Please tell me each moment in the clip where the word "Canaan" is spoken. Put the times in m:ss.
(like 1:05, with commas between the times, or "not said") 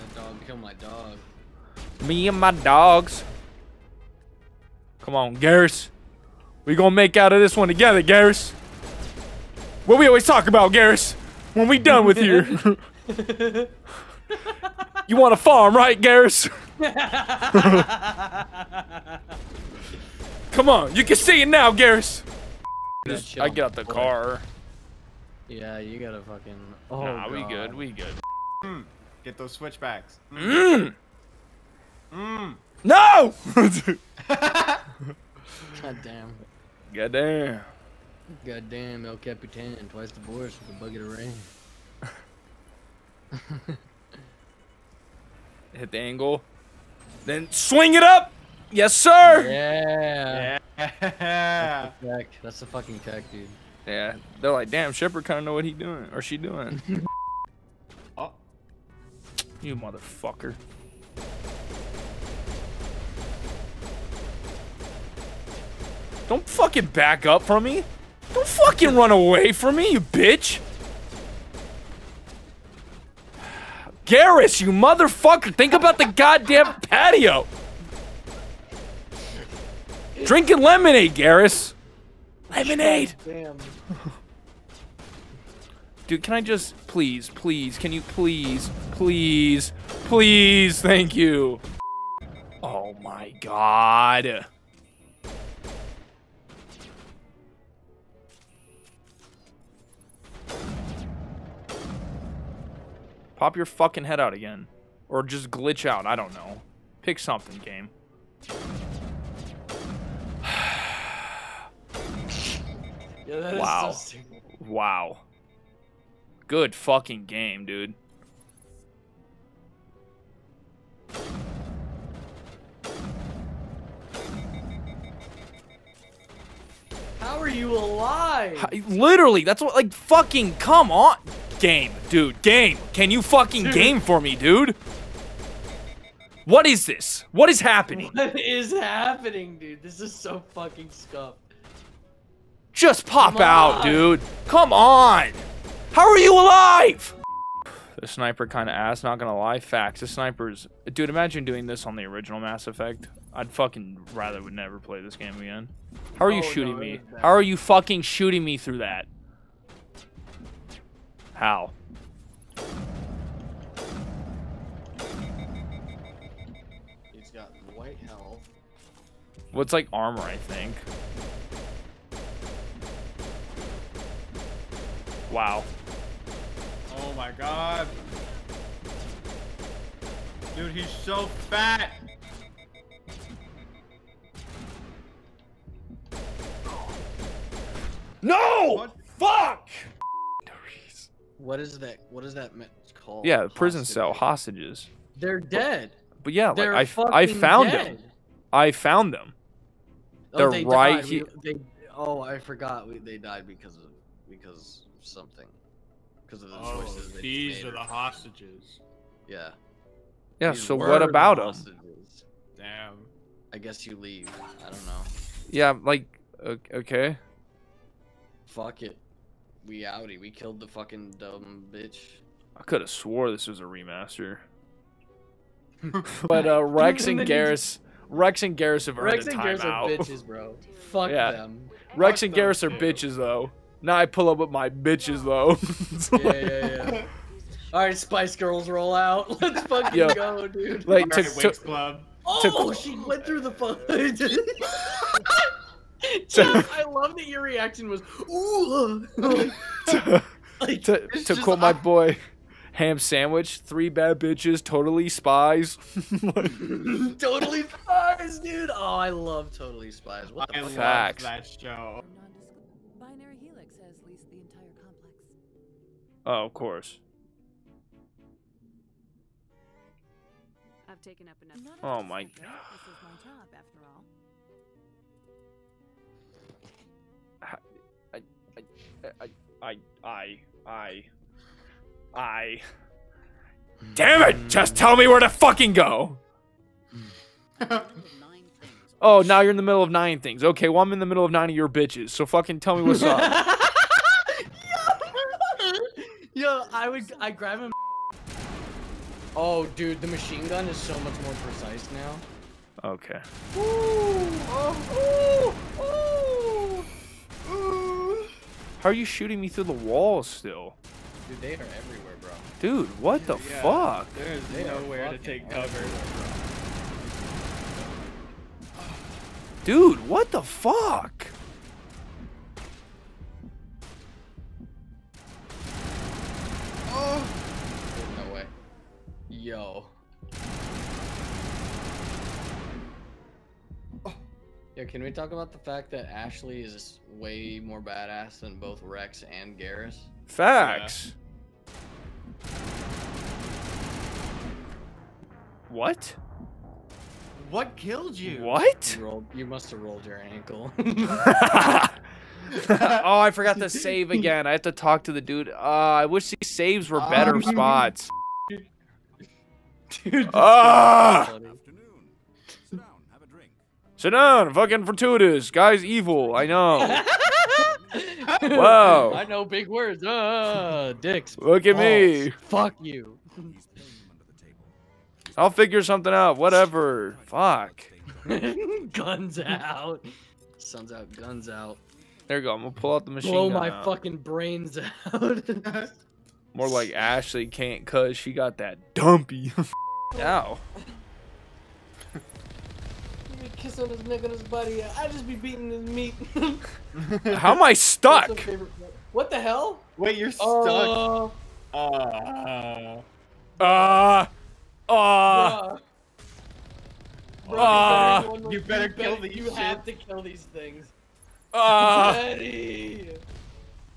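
not said.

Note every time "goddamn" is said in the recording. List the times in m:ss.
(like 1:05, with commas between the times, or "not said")
0:38, 1:16.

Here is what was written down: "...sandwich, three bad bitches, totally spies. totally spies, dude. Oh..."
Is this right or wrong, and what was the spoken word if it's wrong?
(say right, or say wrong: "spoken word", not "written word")
right.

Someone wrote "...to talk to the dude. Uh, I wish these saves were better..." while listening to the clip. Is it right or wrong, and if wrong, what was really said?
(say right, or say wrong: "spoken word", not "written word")
right.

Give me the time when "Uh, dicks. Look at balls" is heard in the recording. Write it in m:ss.
6:10.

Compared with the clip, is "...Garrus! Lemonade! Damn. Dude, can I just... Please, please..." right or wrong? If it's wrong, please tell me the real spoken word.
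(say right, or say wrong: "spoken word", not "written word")
right.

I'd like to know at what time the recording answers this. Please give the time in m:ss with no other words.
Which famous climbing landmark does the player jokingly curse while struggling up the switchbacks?
0:39.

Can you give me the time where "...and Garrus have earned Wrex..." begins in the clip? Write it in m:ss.
3:48.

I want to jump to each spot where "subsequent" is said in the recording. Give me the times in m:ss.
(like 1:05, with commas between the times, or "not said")
not said.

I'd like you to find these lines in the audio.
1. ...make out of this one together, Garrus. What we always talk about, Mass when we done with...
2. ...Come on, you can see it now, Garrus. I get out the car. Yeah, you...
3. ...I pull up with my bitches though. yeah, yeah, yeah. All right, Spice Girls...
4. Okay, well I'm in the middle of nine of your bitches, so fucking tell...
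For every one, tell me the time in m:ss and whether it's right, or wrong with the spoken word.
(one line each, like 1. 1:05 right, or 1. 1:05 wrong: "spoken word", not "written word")
1. 0:06 wrong: "Garrus", not "Mass"
2. 0:20 right
3. 3:53 right
4. 4:50 right.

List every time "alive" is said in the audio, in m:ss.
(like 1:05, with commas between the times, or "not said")
2:07, 2:26.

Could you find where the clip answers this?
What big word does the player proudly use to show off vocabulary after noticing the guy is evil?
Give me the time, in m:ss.
6:04.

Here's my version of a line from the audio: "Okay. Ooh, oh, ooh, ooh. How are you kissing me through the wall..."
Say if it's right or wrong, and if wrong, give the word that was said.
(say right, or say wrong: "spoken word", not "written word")
wrong: "shooting", not "kissing".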